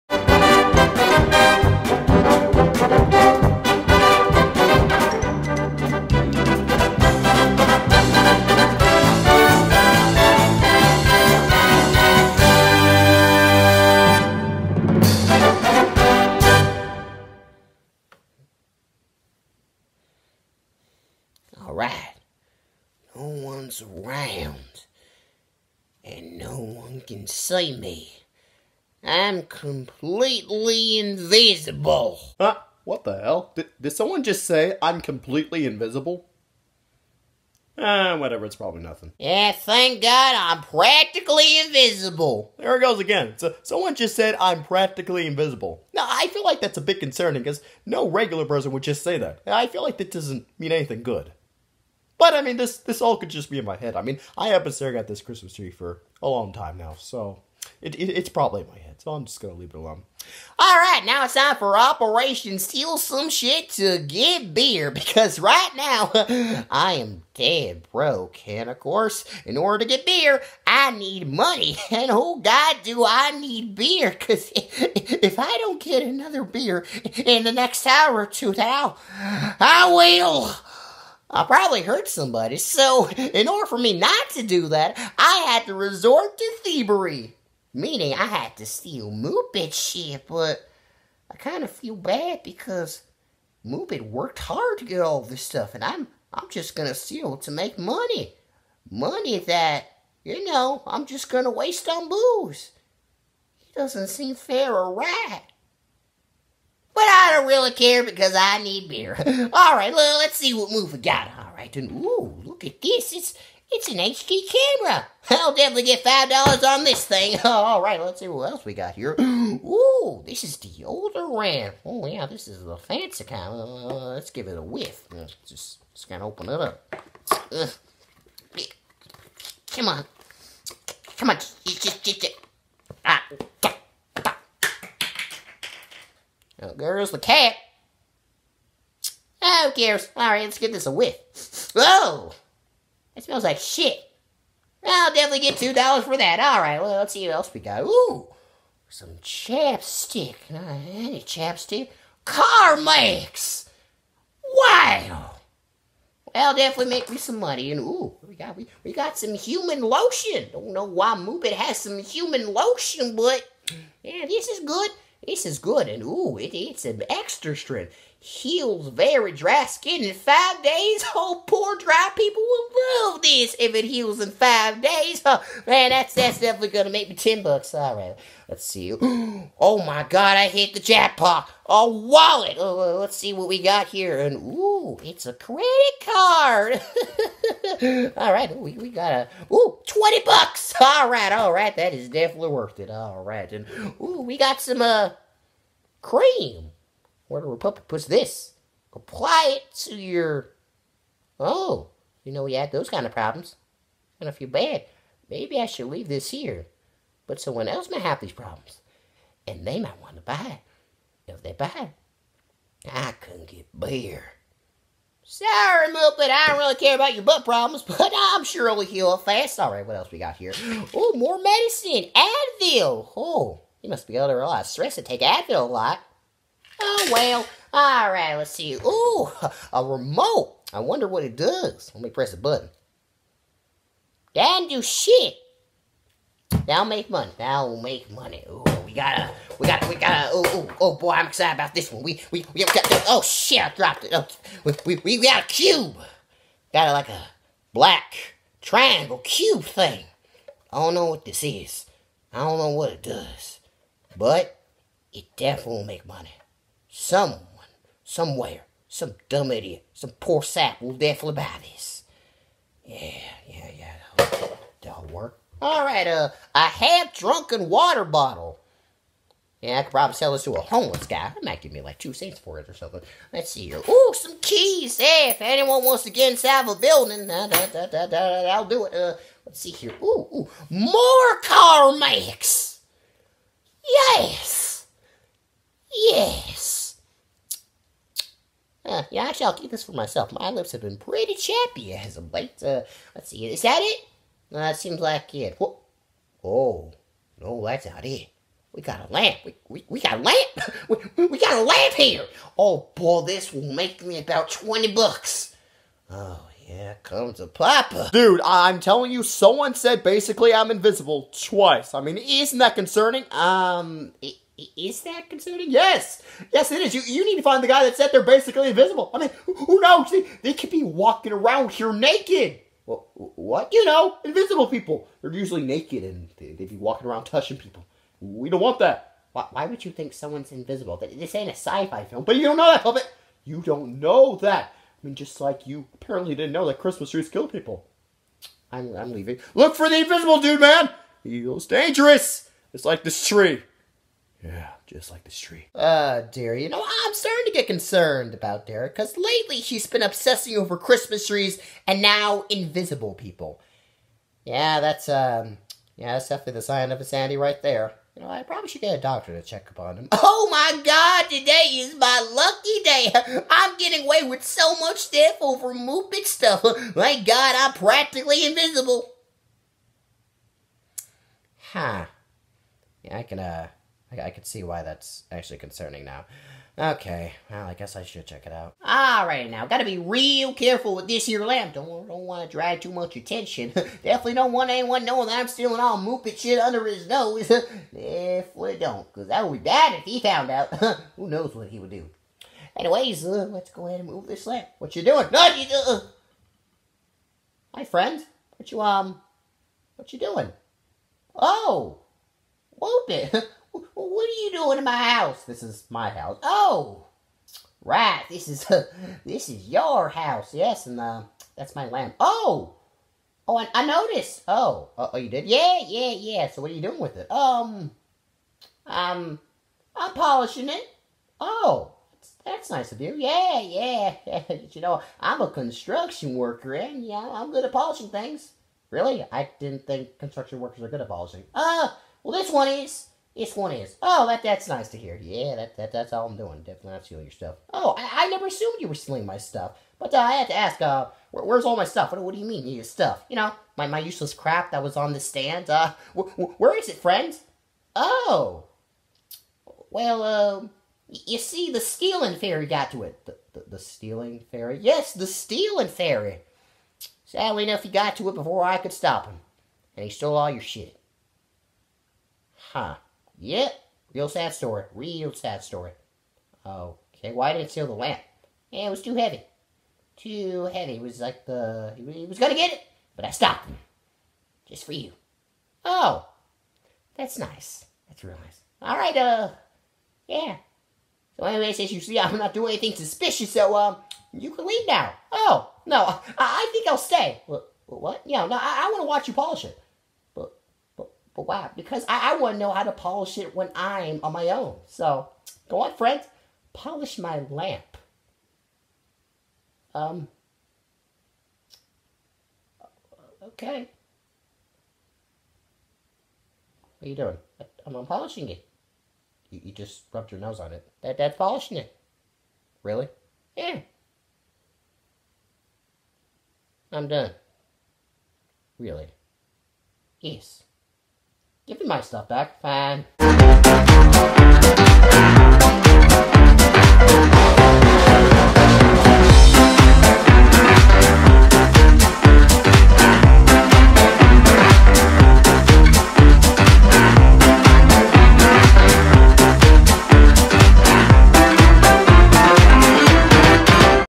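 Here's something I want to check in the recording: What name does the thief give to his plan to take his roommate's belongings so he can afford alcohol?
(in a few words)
Operation Steal Some Shit to Get Beer.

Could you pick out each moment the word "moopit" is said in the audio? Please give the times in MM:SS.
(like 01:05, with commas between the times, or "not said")
01:29, 01:33, 02:41, 06:05, 06:25, 06:42.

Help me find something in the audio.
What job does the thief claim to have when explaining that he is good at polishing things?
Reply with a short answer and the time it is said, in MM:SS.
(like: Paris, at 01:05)
construction worker, at 07:05.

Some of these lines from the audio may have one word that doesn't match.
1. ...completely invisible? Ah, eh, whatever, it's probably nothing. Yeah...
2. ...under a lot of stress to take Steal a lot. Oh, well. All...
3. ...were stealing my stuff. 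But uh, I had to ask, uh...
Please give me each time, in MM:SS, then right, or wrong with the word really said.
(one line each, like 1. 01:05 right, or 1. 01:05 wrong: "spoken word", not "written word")
1. 00:35 right
2. 03:44 wrong: "Advil", not "Steal"
3. 07:18 right.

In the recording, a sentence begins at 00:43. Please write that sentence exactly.
So, someone just said I'm practically invisible.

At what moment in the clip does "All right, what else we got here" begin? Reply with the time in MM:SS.
03:39.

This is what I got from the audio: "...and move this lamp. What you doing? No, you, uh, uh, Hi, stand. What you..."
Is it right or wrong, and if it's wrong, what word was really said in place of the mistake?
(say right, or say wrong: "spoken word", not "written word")
wrong: "friend", not "stand".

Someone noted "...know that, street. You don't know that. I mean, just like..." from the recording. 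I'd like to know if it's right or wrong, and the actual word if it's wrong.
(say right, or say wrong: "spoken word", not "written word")
wrong: "puppet", not "street".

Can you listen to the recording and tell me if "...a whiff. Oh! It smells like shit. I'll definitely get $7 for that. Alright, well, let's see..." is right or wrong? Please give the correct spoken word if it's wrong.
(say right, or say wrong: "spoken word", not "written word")
wrong: "2", not "7".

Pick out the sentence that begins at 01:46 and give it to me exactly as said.
But I don't really care because I need beer.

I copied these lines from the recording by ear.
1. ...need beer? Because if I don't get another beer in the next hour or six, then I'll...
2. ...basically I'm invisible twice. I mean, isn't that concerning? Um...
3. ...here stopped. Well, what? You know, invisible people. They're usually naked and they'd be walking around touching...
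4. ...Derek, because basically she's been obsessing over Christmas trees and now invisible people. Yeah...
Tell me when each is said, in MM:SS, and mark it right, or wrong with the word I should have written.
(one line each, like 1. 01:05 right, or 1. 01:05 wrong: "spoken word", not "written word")
1. 01:13 wrong: "two", not "six"
2. 05:10 right
3. 05:21 wrong: "naked", not "stopped"
4. 05:48 wrong: "lately", not "basically".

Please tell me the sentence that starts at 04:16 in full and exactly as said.
Someone, somewhere, some dumb idiot, some poor sap will definitely buy this.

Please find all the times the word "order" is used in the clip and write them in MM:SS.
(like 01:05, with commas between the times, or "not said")
01:09, 01:23.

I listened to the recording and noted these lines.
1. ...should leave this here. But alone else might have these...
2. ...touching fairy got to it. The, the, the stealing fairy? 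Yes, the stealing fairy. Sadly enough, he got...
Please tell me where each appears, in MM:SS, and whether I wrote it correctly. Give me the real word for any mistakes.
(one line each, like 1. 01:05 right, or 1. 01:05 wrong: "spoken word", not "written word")
1. 03:25 wrong: "someone", not "alone"
2. 07:31 wrong: "stealing", not "touching".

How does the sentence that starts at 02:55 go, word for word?
Oh, man, that's that's definitely gonna make me ten bucks.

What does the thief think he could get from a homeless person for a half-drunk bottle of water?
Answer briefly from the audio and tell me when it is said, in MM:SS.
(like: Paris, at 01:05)
2 cents, at 04:31.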